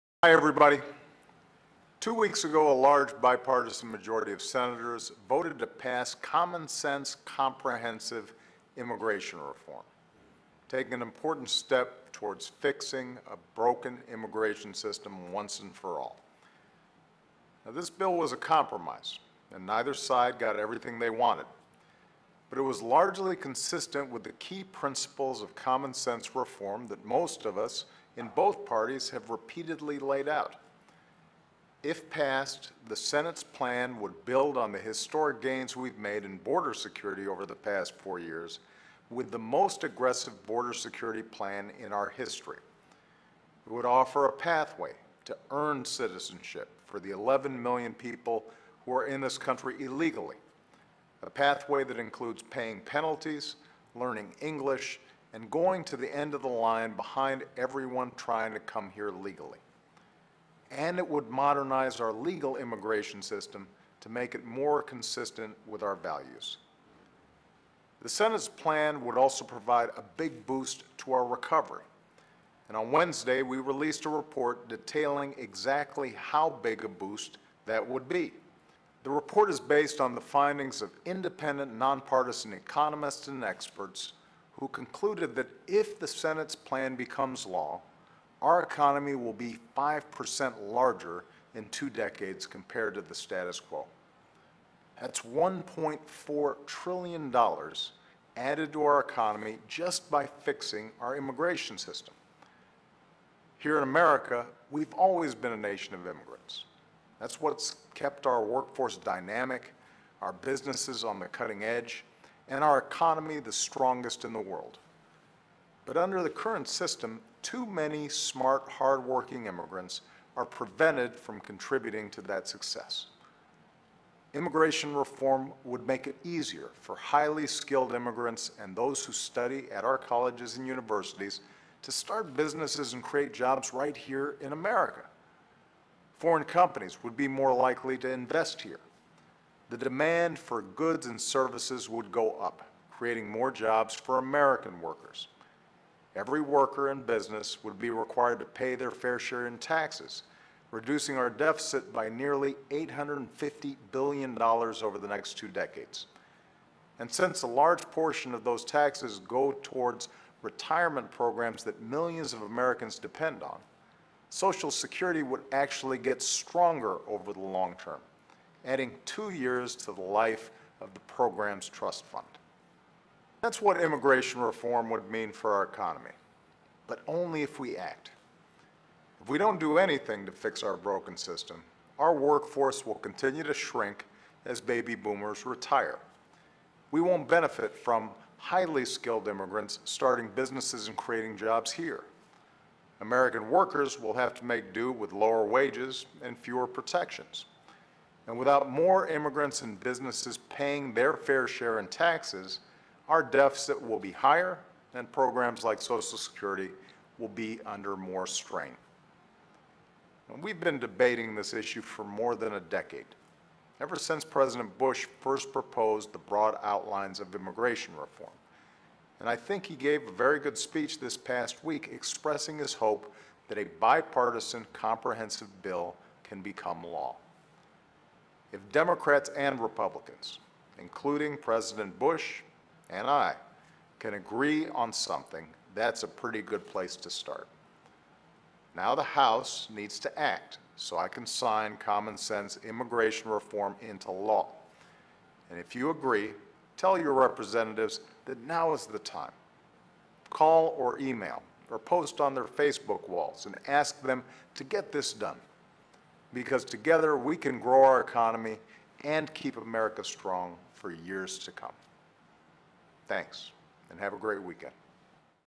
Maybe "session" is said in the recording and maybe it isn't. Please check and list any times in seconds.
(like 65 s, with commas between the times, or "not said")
not said.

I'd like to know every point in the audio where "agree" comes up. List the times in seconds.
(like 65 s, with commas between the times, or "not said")
234 s, 245 s.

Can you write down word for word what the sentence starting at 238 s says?
Now the House needs to act so I can sign common sense immigration reform into law.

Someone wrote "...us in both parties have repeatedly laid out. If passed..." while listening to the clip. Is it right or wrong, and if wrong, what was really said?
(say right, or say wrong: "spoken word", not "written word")
right.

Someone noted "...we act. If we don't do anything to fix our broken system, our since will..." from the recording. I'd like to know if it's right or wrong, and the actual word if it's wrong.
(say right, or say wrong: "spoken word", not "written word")
wrong: "workforce", not "since".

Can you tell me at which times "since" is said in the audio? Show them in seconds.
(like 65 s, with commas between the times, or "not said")
157 s, 213 s.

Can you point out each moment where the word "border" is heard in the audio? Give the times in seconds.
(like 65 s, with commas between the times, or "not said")
36 s, 40 s.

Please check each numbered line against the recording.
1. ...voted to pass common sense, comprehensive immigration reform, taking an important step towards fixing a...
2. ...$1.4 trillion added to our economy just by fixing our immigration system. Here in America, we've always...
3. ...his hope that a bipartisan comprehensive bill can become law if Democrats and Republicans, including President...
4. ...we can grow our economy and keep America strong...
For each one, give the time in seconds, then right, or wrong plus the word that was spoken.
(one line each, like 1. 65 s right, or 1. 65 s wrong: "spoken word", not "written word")
1. 5 s right
2. 95 s right
3. 222 s right
4. 257 s right.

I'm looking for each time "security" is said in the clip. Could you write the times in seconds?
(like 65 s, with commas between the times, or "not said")
36 s, 40 s, 164 s, 206 s.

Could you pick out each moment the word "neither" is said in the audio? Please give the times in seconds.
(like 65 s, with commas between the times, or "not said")
19 s.